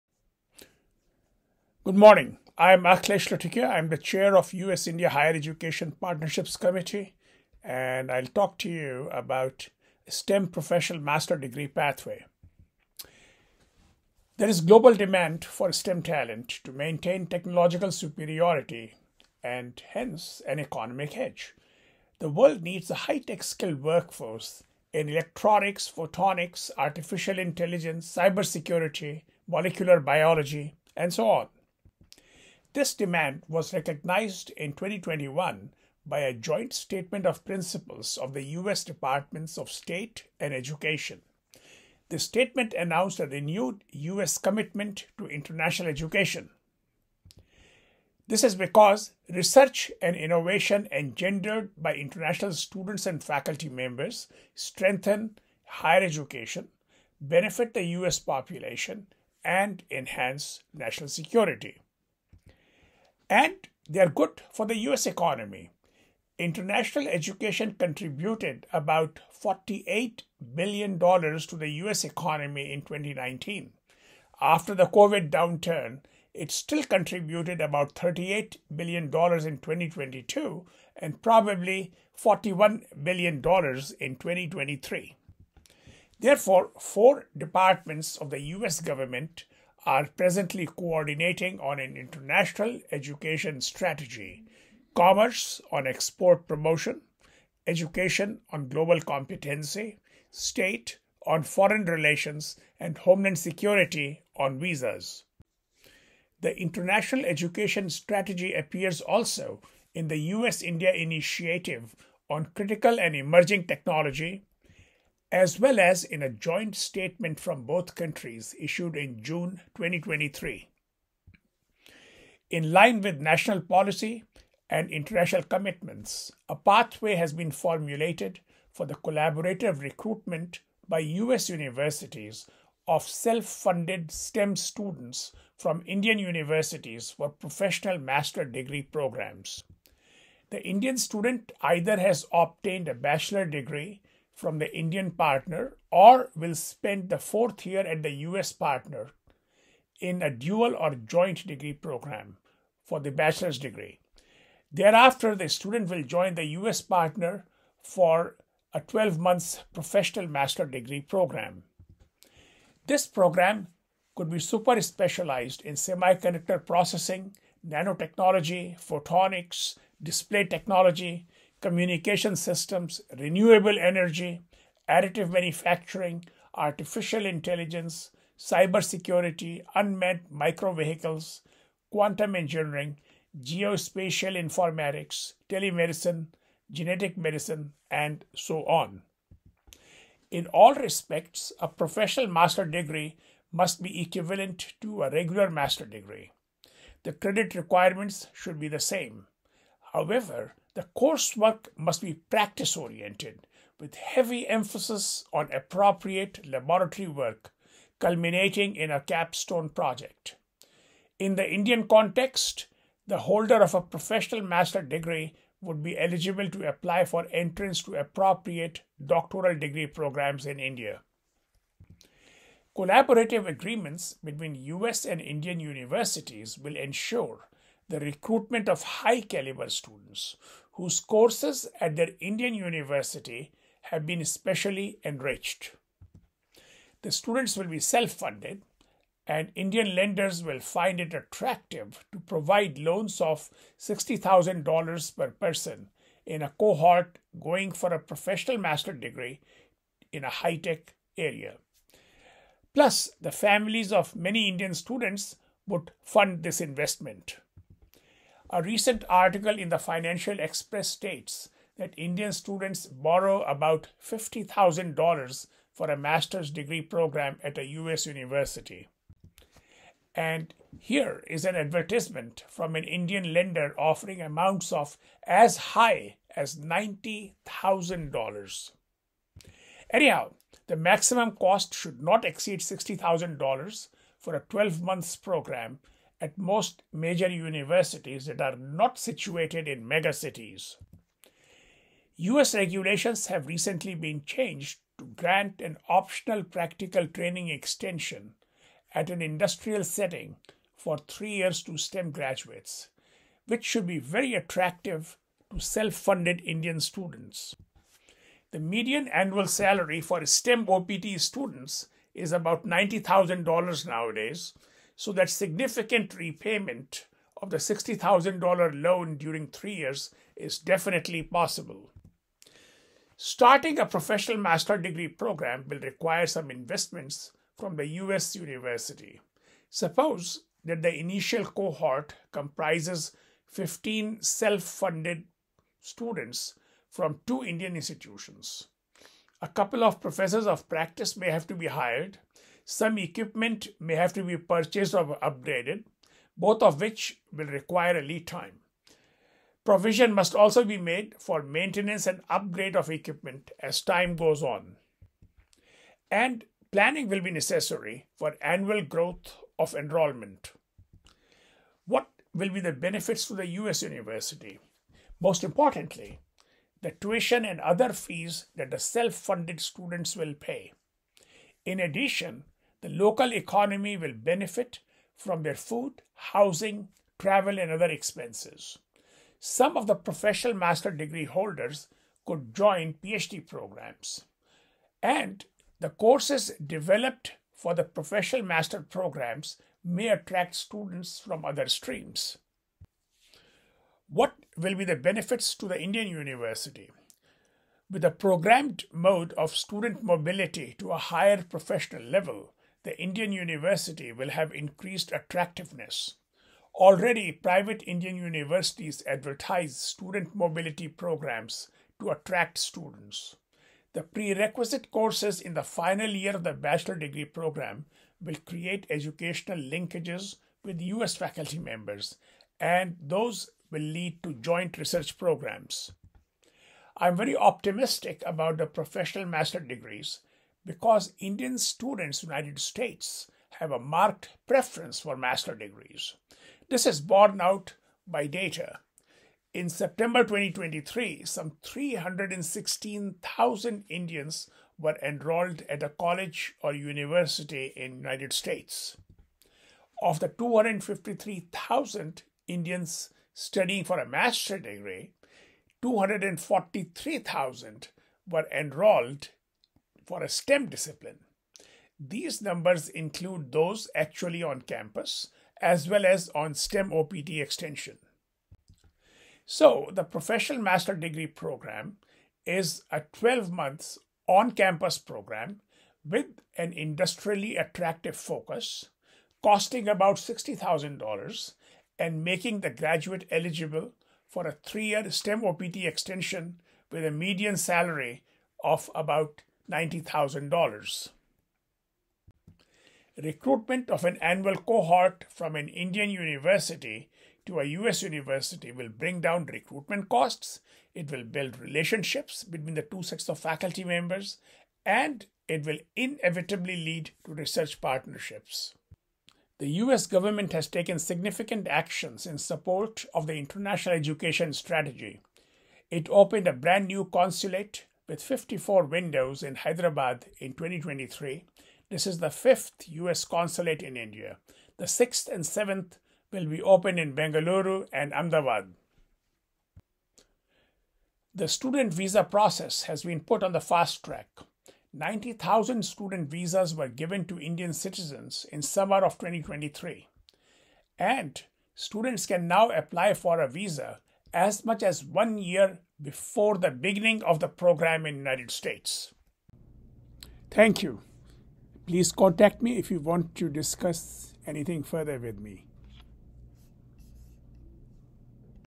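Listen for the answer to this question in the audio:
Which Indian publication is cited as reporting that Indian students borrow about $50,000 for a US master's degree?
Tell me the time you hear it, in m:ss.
4:19.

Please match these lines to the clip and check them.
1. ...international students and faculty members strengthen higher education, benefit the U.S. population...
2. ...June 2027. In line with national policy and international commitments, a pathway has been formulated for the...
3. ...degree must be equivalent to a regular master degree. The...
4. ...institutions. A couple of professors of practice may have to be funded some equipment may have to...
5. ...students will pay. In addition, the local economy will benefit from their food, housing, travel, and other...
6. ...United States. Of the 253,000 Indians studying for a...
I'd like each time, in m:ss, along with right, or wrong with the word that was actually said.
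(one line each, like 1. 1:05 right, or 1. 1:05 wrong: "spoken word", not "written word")
1. 0:51 right
2. 1:59 wrong: "2023", not "2027"
3. 3:12 right
4. 5:37 wrong: "hired", not "funded"
5. 6:09 right
6. 7:27 right.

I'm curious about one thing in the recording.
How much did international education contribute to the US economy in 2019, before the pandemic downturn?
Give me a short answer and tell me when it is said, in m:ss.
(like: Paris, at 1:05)
$48 billion, at 1:09.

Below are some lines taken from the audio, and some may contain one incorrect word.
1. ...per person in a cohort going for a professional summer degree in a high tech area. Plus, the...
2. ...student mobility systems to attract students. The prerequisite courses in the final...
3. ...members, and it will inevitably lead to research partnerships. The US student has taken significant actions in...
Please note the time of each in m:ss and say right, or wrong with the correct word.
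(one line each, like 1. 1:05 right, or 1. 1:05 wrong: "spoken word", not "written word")
1. 4:05 wrong: "master", not "summer"
2. 6:49 wrong: "programs", not "systems"
3. 8:23 wrong: "government", not "student".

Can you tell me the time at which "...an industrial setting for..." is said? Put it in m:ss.
4:59.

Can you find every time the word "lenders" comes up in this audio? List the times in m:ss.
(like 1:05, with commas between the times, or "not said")
3:59, 4:33.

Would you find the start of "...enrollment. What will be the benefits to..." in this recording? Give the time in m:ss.
5:59.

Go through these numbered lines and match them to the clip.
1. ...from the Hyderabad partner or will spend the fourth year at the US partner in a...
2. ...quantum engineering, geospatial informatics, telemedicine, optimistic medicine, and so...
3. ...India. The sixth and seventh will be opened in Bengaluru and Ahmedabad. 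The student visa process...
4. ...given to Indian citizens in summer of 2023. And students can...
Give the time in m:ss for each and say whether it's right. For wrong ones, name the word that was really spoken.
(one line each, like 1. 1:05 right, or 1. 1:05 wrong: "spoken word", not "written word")
1. 2:24 wrong: "Indian", not "Hyderabad"
2. 3:01 wrong: "genetic", not "optimistic"
3. 8:43 right
4. 8:56 right.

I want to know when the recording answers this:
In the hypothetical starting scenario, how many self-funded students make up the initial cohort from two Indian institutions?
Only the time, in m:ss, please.
5:33.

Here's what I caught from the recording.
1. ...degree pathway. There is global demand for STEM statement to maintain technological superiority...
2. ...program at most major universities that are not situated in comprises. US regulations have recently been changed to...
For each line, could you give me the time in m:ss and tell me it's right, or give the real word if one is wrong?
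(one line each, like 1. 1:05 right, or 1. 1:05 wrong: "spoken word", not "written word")
1. 0:11 wrong: "talent", not "statement"
2. 4:45 wrong: "megacities", not "comprises".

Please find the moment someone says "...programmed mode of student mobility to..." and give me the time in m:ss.
6:38.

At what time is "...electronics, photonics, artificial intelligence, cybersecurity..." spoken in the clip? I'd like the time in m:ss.
0:25.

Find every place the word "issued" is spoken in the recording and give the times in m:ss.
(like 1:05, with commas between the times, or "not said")
1:58.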